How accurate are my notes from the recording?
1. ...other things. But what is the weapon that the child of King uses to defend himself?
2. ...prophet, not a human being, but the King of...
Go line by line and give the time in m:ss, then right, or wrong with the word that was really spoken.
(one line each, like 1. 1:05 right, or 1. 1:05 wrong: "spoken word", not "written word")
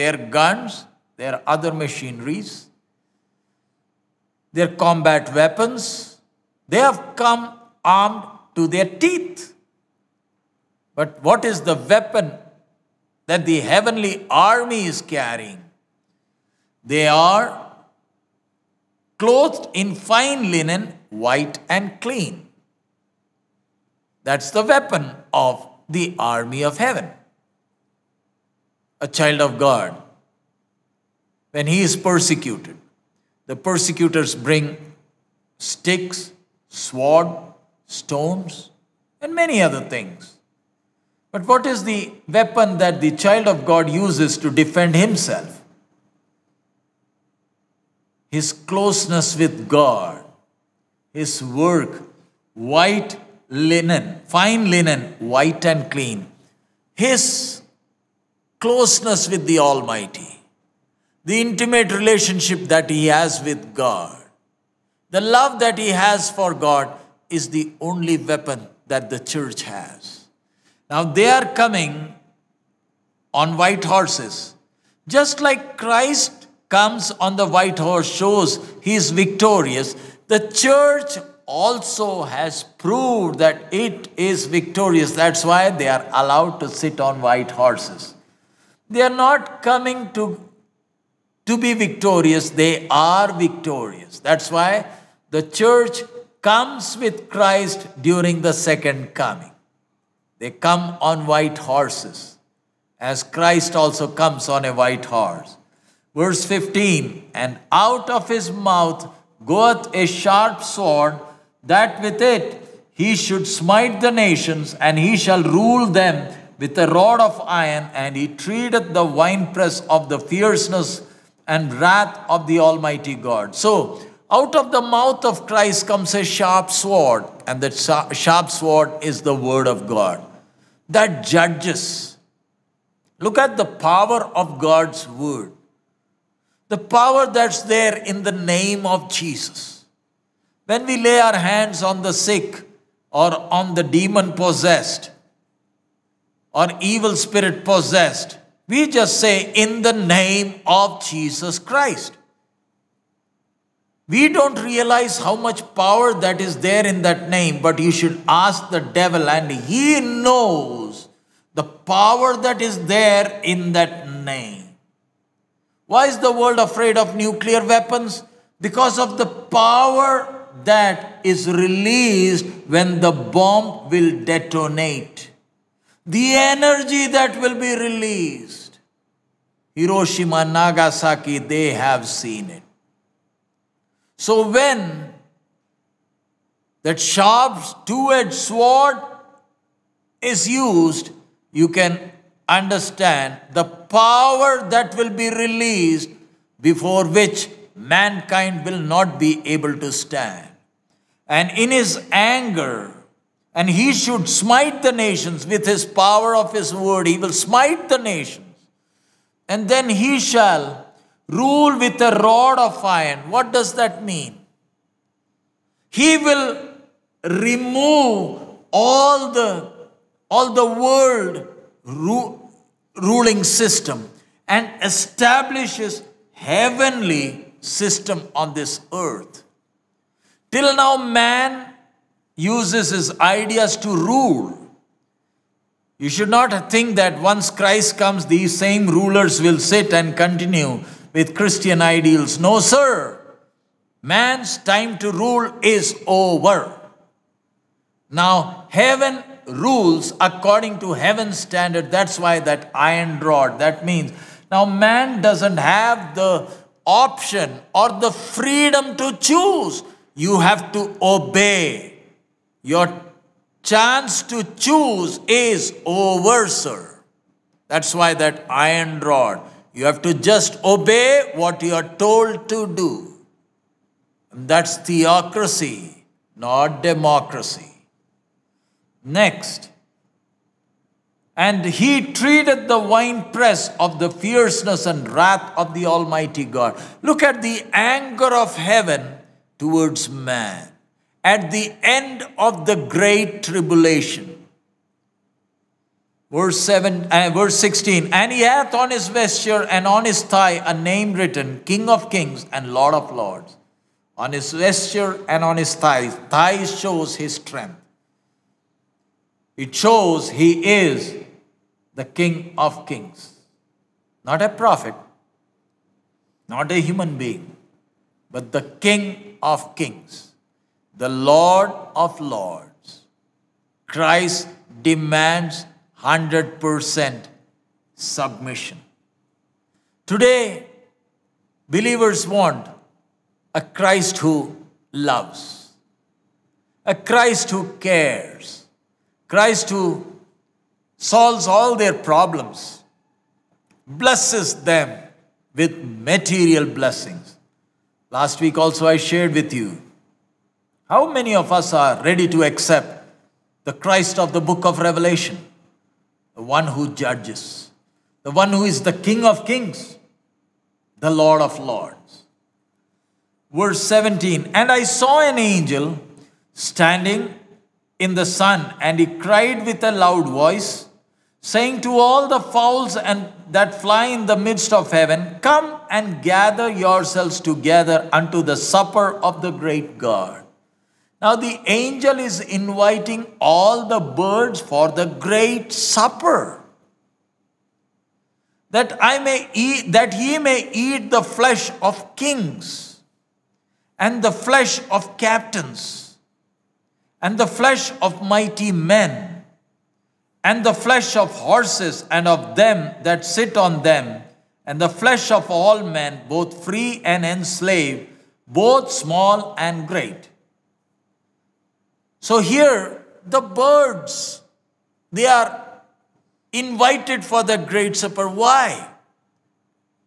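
1. 0:39 wrong: "God", not "King"
2. 5:14 right.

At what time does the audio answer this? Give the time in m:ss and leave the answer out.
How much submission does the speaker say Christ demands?
5:26.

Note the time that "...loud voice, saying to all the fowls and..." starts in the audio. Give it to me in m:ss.
6:09.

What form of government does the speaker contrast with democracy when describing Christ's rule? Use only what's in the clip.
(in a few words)
theocracy.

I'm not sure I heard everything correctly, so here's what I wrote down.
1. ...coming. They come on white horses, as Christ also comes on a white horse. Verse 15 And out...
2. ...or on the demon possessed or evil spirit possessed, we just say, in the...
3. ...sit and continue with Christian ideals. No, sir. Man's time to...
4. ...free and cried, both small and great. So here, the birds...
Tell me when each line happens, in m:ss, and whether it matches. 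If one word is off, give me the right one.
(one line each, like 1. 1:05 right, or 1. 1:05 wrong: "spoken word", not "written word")
1. 1:39 right
2. 2:23 right
3. 3:59 right
4. 6:46 wrong: "enslaved", not "cried".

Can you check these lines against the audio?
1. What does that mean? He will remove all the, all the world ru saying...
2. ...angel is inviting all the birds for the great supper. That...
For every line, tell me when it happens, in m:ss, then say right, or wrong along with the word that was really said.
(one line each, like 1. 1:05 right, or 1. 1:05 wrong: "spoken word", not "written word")
1. 3:33 wrong: "ruling", not "saying"
2. 6:21 right.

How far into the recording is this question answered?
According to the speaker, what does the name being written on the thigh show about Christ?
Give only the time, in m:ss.
5:07.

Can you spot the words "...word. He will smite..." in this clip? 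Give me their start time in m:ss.
3:26.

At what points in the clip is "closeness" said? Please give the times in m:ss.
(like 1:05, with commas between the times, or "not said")
0:48, 0:58.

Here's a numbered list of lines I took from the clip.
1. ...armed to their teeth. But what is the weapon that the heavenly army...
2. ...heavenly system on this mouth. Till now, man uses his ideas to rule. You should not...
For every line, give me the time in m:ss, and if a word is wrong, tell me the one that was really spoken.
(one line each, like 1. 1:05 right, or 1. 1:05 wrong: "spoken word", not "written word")
1. 0:07 right
2. 3:46 wrong: "earth", not "mouth".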